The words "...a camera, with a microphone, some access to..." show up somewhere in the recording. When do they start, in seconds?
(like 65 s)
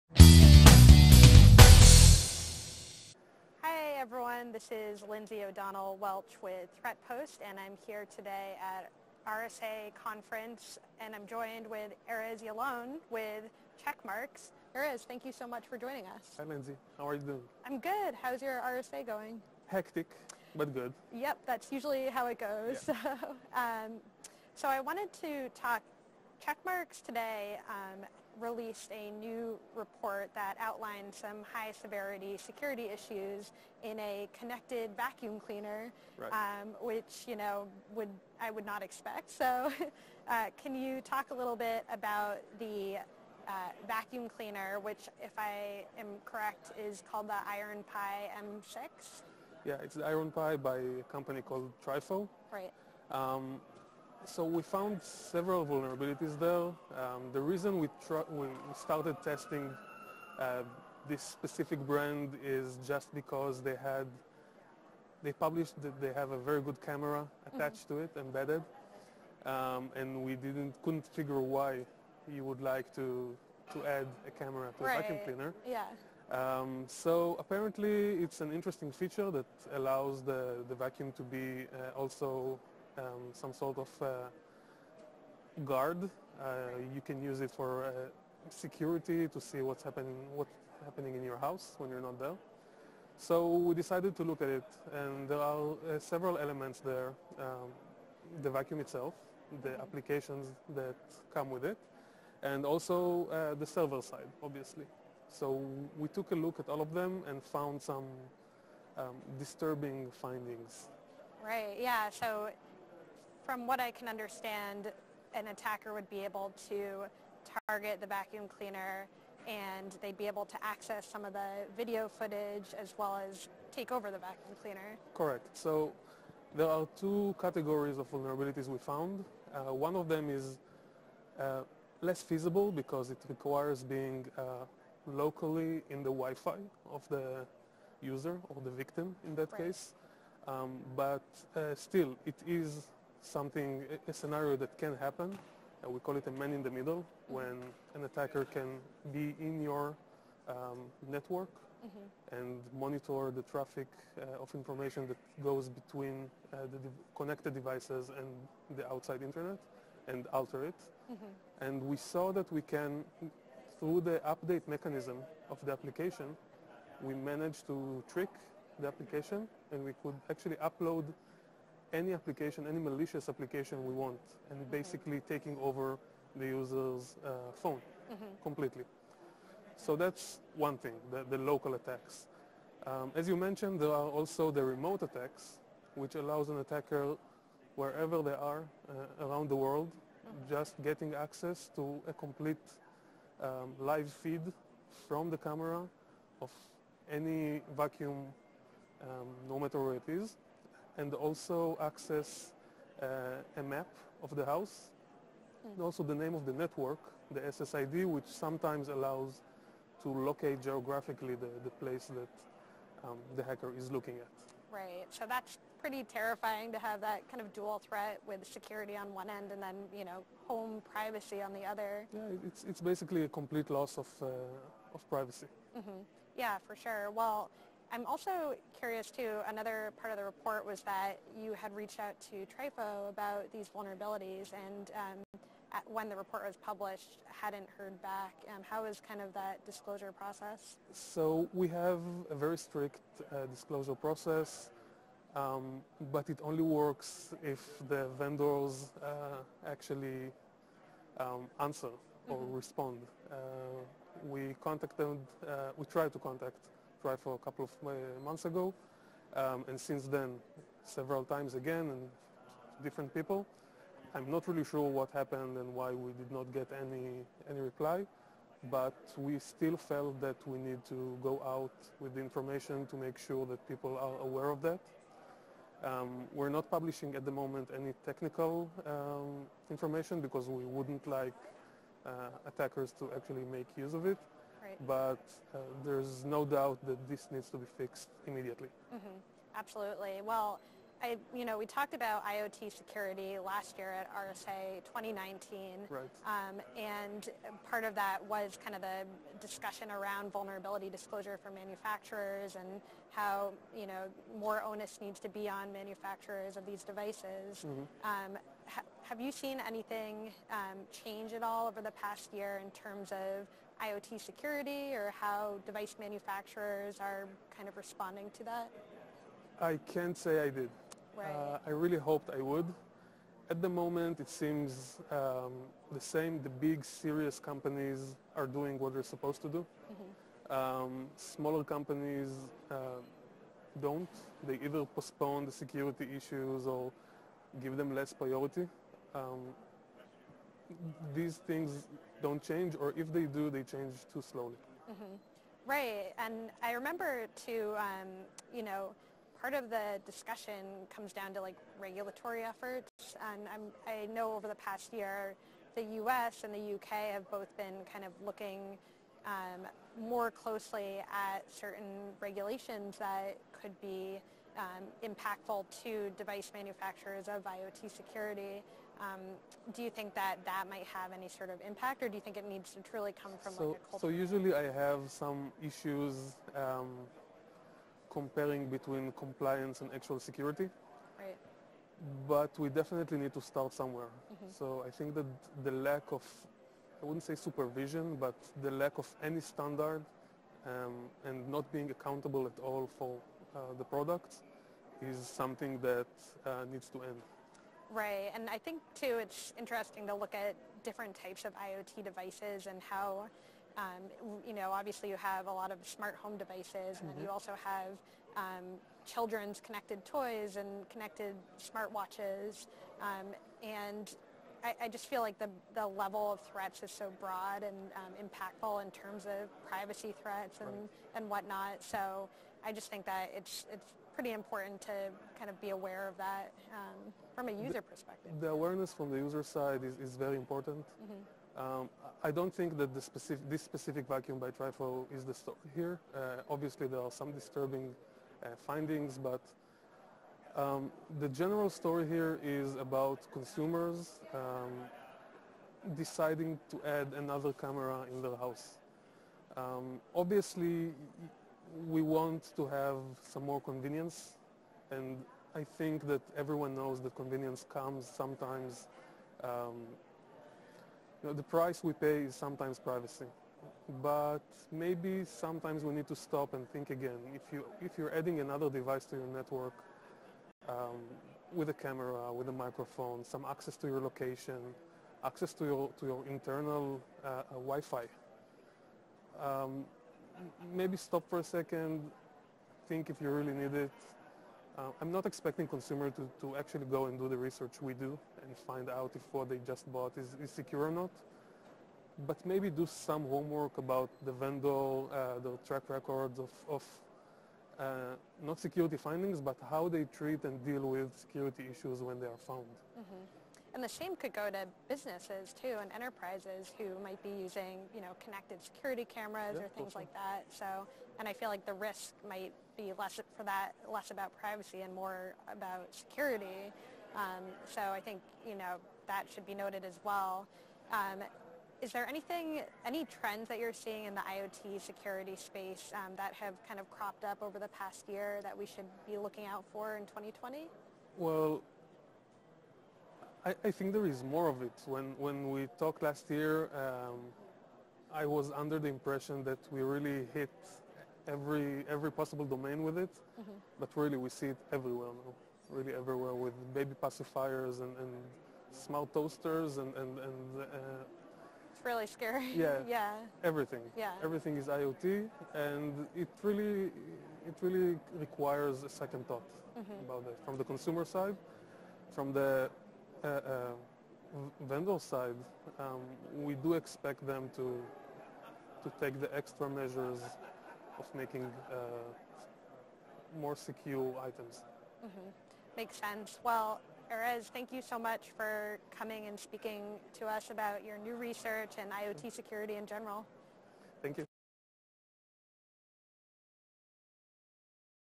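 471 s.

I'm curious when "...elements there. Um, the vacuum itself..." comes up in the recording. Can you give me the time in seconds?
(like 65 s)
96 s.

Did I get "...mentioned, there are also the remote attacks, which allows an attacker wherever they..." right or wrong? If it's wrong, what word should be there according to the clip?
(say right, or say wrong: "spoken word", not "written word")
right.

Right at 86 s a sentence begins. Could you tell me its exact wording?
Uh, you can use it for uh, security to see what's happening, what's happening in your house when you're not there.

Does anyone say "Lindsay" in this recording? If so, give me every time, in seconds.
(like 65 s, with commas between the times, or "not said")
5 s, 16 s.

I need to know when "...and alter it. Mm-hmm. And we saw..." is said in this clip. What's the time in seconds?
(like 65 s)
160 s.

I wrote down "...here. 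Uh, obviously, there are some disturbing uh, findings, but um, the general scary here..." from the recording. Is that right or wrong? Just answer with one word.
wrong.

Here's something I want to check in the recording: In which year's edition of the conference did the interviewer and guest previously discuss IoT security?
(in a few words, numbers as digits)
2019.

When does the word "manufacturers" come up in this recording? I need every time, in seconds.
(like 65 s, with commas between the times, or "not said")
301 s, 305 s, 315 s, 366 s.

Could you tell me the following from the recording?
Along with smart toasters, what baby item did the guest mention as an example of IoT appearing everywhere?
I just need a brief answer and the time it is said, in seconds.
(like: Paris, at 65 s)
baby pacifiers, at 546 s.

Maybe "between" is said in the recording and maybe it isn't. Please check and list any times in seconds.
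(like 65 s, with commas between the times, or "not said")
155 s, 378 s.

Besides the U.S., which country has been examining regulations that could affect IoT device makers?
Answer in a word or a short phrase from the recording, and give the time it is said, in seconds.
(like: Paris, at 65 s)
U.K., at 356 s.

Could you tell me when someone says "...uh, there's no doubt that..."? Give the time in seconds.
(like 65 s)
285 s.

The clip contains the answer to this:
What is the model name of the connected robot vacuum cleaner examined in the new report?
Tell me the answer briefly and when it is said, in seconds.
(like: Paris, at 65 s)
Ironpie M6, at 47 s.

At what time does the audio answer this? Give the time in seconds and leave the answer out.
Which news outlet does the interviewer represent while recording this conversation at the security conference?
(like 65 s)
6 s.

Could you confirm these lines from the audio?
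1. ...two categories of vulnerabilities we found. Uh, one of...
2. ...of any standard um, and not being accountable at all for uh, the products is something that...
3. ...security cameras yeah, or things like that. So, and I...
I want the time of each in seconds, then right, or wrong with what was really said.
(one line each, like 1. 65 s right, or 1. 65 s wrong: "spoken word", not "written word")
1. 126 s right
2. 388 s right
3. 508 s right.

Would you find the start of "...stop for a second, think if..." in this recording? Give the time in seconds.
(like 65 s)
480 s.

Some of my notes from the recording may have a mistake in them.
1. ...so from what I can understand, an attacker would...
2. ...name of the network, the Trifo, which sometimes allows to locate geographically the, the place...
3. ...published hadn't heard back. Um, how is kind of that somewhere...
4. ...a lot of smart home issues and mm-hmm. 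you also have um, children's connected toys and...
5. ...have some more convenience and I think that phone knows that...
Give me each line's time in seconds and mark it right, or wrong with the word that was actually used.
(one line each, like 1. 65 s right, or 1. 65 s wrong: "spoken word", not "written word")
1. 112 s right
2. 206 s wrong: "SSID", not "Trifo"
3. 236 s wrong: "disclosure", not "somewhere"
4. 405 s wrong: "devices", not "issues"
5. 452 s wrong: "everyone", not "phone".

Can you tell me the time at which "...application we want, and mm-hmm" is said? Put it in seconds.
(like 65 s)
173 s.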